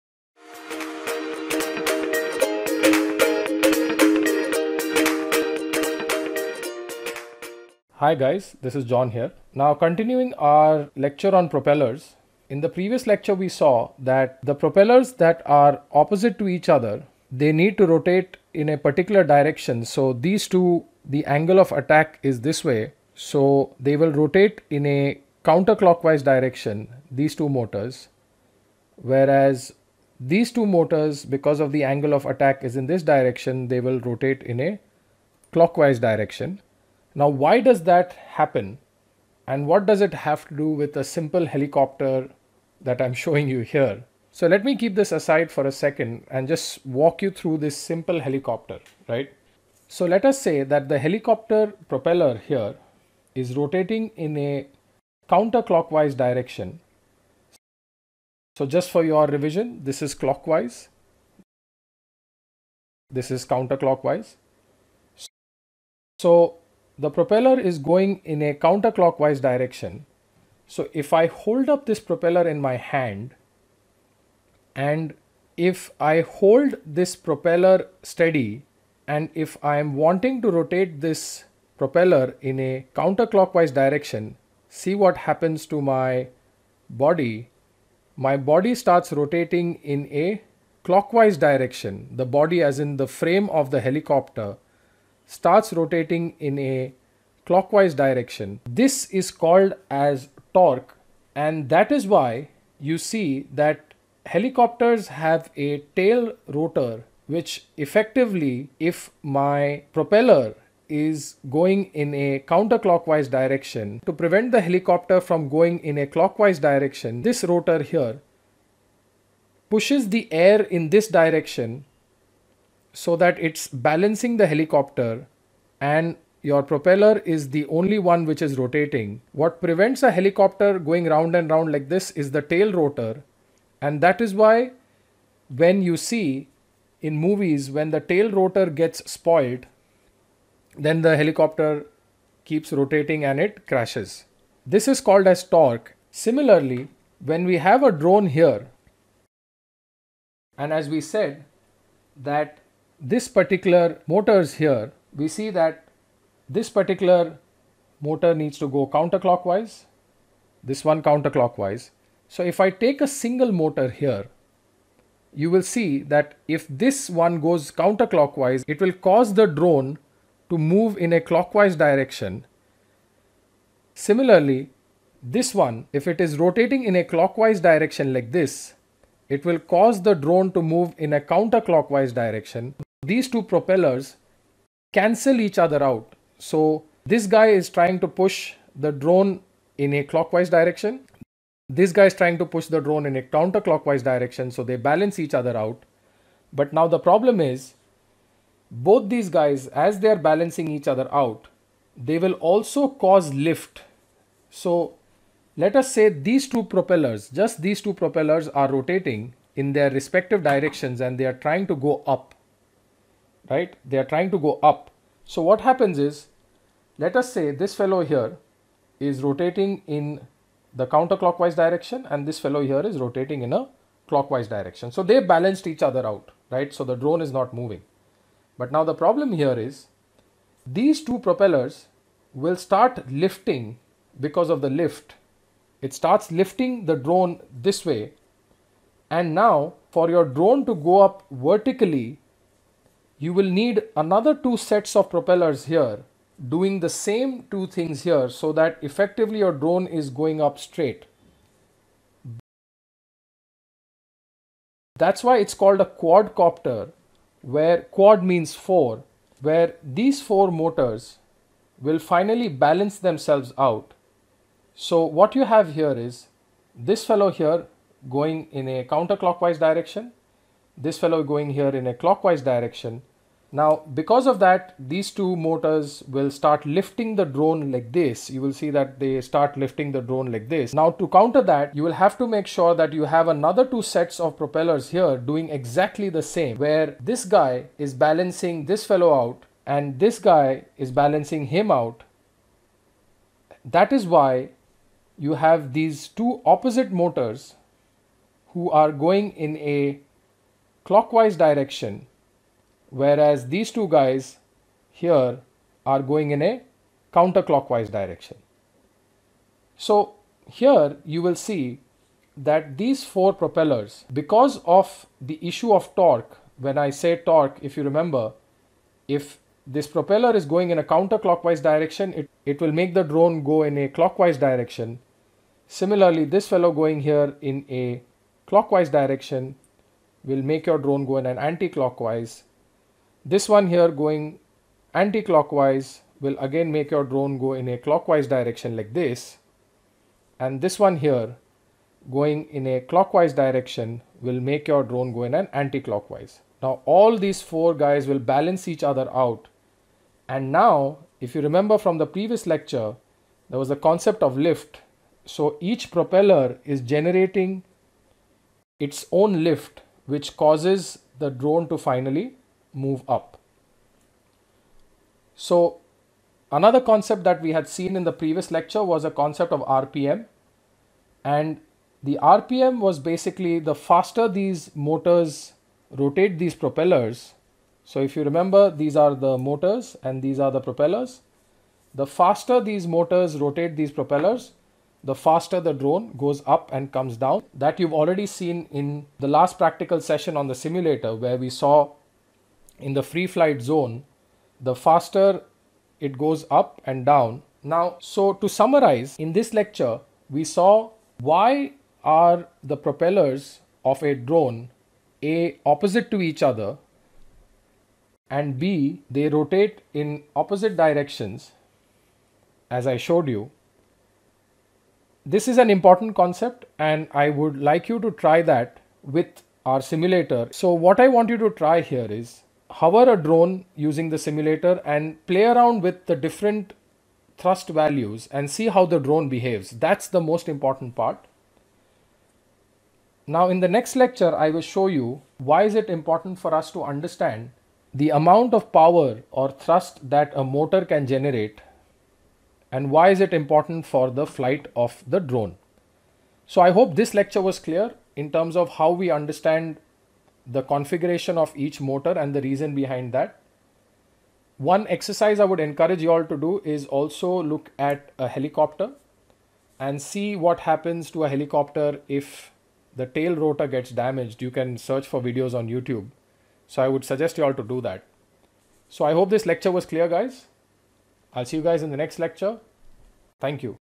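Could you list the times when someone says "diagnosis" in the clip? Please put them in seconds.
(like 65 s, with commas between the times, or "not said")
not said.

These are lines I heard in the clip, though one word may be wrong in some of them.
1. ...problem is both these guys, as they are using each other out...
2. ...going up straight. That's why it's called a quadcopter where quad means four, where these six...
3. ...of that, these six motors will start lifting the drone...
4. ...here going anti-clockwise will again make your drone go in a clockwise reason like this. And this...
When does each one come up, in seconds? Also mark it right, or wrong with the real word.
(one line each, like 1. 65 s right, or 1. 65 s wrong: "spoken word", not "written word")
1. 196 s wrong: "balancing", not "using"
2. 250 s wrong: "four", not "six"
3. 274 s wrong: "two", not "six"
4. 333 s wrong: "direction", not "reason".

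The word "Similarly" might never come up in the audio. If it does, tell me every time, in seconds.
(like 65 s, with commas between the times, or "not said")
146 s, 173 s, 325 s.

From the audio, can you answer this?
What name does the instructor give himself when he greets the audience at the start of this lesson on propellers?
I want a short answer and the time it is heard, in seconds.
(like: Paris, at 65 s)
John, at 8 s.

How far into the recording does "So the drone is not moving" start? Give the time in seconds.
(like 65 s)
226 s.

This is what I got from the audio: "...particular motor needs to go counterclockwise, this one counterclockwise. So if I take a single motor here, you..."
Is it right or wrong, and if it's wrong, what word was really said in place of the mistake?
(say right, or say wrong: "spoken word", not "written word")
right.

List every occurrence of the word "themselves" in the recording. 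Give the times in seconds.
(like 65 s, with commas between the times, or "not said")
262 s.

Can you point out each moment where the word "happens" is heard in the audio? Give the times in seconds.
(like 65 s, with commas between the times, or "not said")
38 s, 85 s, 215 s, 460 s.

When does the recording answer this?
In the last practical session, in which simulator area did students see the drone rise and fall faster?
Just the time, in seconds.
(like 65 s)
393 s.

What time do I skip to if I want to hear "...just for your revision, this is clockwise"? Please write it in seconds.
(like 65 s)
58 s.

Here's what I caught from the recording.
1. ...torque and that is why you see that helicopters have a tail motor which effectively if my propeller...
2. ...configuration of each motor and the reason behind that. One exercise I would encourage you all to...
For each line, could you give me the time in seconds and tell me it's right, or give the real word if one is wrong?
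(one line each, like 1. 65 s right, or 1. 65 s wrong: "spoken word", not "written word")
1. 100 s wrong: "rotor", not "motor"
2. 450 s right.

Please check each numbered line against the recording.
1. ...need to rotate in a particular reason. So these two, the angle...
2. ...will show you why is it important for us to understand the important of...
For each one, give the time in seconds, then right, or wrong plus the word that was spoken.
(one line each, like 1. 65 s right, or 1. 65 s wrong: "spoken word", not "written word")
1. 17 s wrong: "direction", not "reason"
2. 434 s wrong: "amount", not "important".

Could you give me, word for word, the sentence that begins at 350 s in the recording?
And now, if you remember from the previous lecture, there was a concept of lift.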